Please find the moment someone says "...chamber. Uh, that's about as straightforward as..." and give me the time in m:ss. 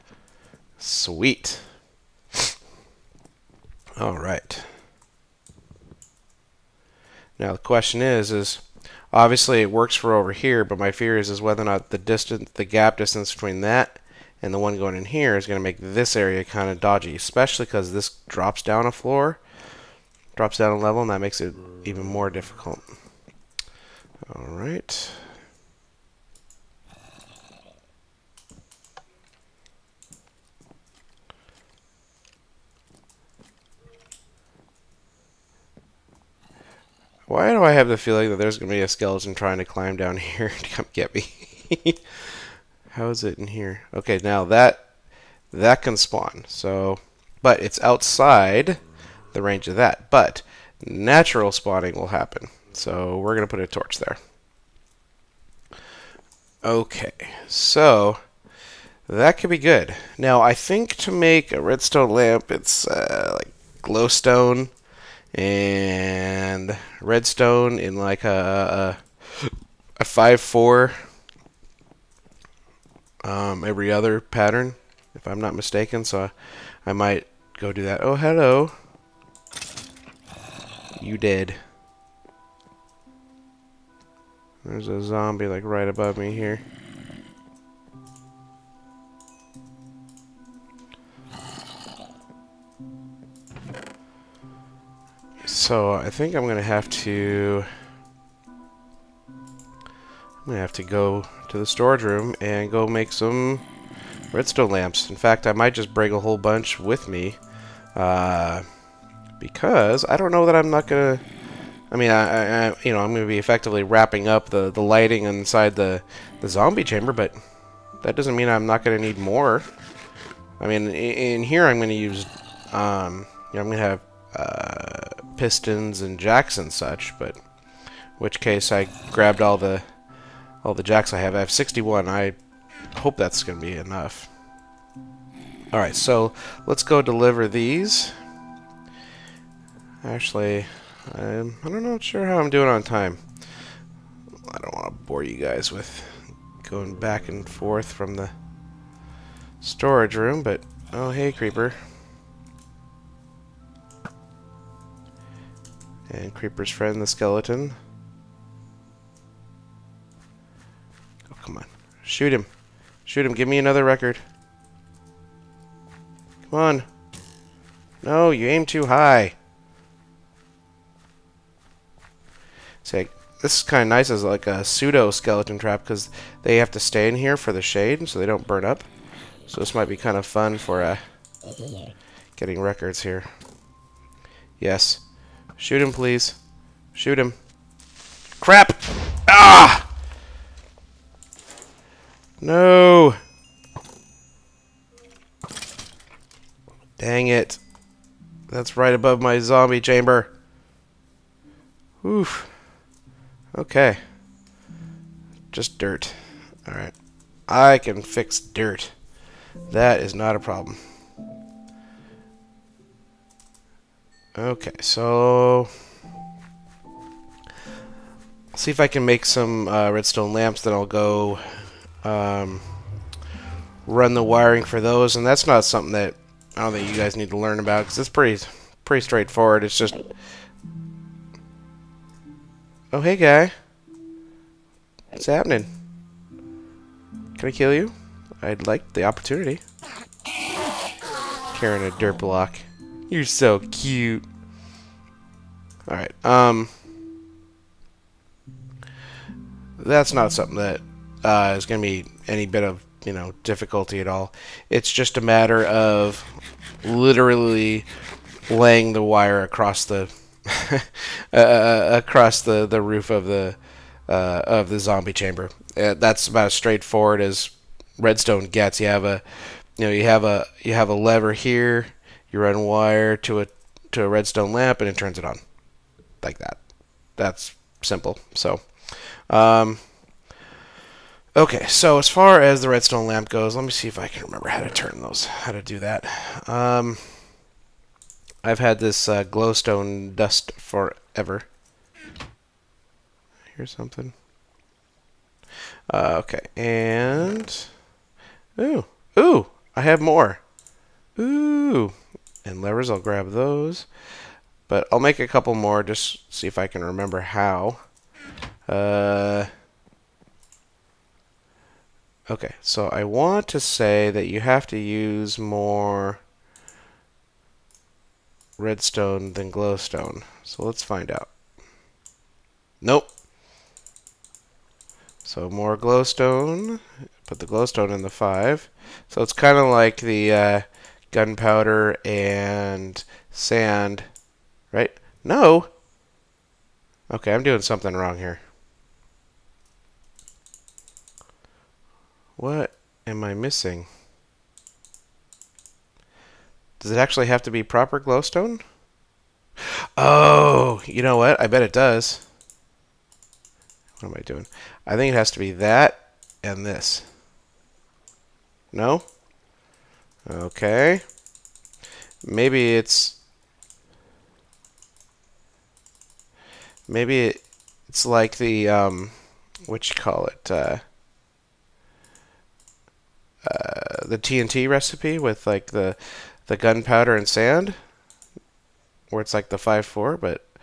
4:25.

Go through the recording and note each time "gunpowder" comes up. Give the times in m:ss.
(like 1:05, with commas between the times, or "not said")
5:31, 6:16.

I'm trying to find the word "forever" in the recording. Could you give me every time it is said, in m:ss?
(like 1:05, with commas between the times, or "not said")
4:50.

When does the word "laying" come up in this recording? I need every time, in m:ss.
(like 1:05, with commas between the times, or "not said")
4:18.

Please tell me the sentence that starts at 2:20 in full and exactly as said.
Actually, I'm, I'm not sure how I'm doing on time.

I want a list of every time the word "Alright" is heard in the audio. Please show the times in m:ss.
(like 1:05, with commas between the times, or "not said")
2:15, 3:26, 4:05.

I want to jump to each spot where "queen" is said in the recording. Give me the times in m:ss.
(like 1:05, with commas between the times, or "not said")
not said.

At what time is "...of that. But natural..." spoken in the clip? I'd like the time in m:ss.
0:49.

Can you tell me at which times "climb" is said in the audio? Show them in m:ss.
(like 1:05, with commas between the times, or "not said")
0:39.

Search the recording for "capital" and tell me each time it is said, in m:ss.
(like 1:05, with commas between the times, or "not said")
not said.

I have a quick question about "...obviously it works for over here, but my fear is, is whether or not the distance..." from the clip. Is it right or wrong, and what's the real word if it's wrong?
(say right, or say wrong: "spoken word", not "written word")
right.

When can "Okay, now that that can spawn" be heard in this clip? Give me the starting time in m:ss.
0:43.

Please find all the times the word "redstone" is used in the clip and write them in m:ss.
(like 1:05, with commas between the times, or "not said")
1:01, 1:06, 1:44, 3:39, 4:27, 4:34, 4:42, 5:18.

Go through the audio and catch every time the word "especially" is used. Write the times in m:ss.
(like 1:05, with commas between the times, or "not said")
0:17.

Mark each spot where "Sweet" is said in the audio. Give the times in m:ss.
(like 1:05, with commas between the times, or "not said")
0:00.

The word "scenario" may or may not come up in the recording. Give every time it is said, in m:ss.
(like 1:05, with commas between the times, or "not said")
not said.